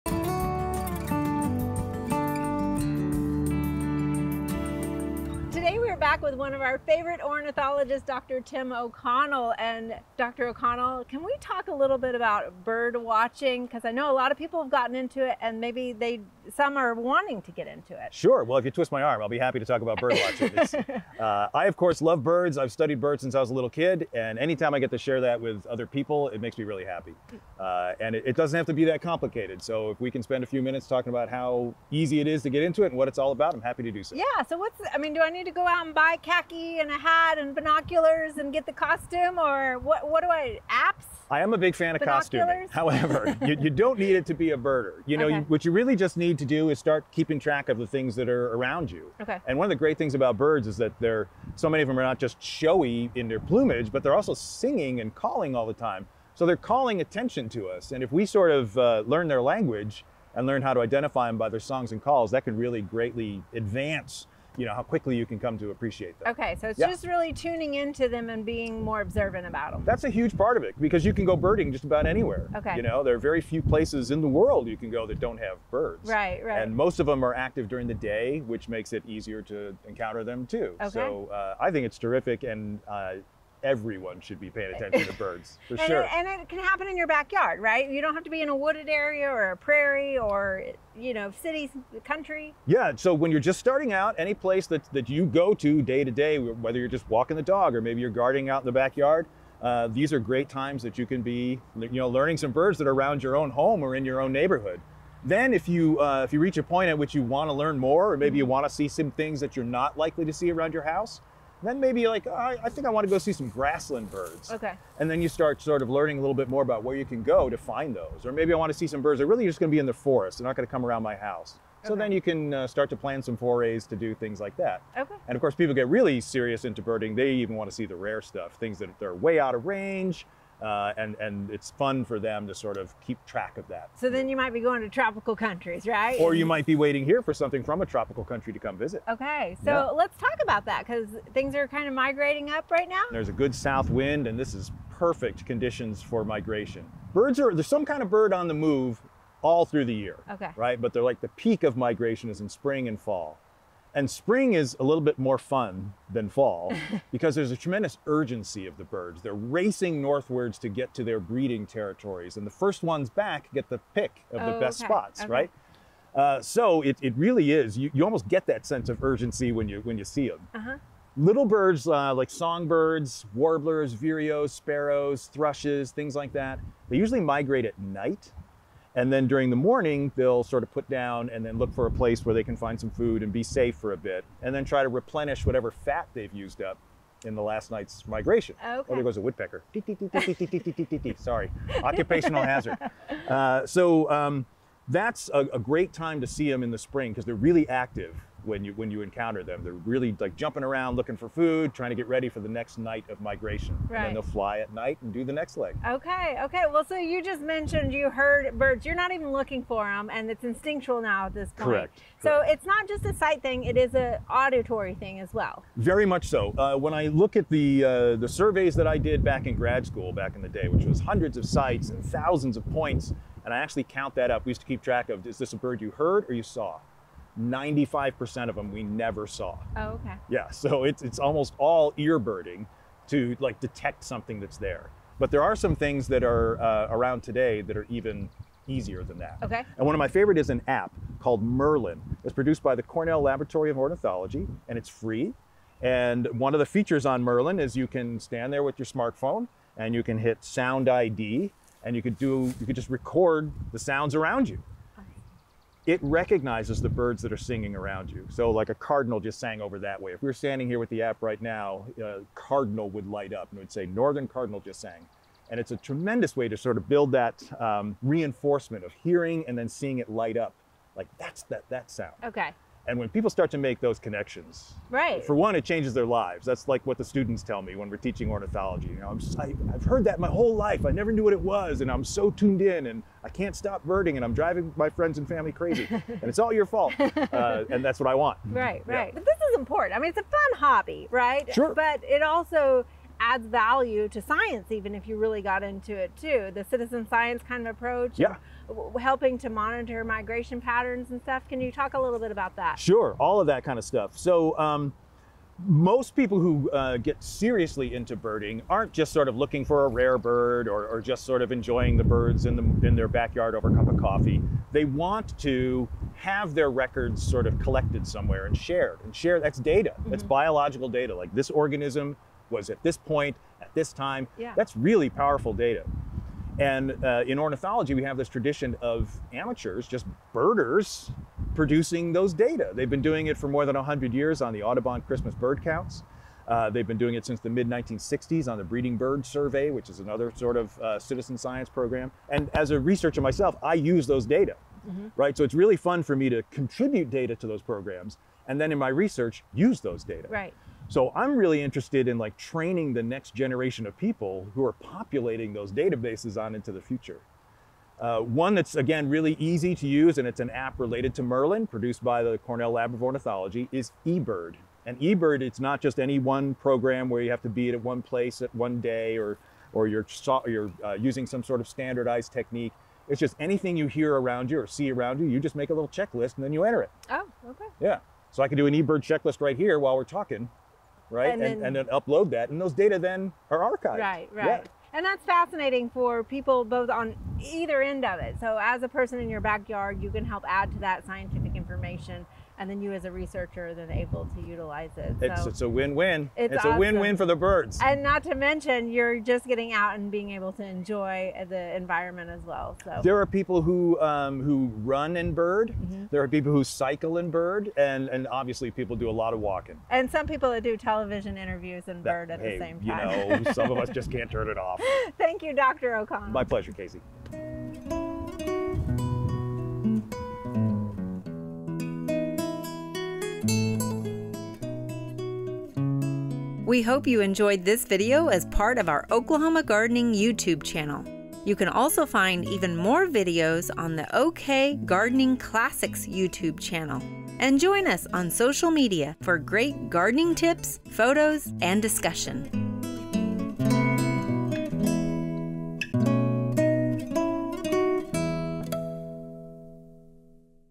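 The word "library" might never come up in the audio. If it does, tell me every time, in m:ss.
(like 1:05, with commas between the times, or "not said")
not said.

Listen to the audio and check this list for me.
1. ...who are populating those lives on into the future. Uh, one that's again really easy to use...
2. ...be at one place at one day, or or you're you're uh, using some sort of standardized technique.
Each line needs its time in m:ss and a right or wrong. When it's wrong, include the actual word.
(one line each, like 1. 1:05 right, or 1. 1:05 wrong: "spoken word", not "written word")
1. 5:54 wrong: "databases", not "lives"
2. 6:07 right.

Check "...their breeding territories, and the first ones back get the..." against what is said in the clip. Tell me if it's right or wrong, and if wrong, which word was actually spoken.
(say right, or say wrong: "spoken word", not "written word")
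right.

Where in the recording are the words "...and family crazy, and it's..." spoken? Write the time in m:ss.
4:45.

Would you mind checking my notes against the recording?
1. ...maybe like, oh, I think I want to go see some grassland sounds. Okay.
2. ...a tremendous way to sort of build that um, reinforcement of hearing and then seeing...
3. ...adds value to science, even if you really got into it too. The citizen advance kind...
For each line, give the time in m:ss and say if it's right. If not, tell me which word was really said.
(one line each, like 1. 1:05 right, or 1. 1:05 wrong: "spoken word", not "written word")
1. 1:51 wrong: "birds", not "sounds"
2. 4:25 right
3. 4:53 wrong: "science", not "advance".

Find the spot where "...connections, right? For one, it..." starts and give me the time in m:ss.
4:33.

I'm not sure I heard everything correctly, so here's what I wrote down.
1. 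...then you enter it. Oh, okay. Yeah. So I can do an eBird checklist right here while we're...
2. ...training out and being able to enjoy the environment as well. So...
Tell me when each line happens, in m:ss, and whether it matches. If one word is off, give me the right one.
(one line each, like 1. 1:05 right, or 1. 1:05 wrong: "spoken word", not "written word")
1. 6:16 right
2. 6:39 wrong: "getting", not "training".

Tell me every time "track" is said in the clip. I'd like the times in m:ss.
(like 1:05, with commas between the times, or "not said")
0:47, 2:13, 3:44.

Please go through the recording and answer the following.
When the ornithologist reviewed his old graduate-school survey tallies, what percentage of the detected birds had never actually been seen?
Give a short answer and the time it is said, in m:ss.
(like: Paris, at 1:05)
95%, at 3:47.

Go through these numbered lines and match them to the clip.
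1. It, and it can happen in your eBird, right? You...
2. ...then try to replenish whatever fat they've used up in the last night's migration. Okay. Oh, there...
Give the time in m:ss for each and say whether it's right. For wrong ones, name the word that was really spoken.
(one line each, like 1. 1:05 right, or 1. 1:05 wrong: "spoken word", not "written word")
1. 1:26 wrong: "backyard", not "eBird"
2. 3:04 right.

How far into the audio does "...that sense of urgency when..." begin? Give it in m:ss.
2:48.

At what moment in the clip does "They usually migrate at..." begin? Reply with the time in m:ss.
2:56.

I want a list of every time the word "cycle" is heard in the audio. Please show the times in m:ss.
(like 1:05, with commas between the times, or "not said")
6:46.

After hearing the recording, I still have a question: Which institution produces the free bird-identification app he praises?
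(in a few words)
Cornell Laboratory of Ornithology.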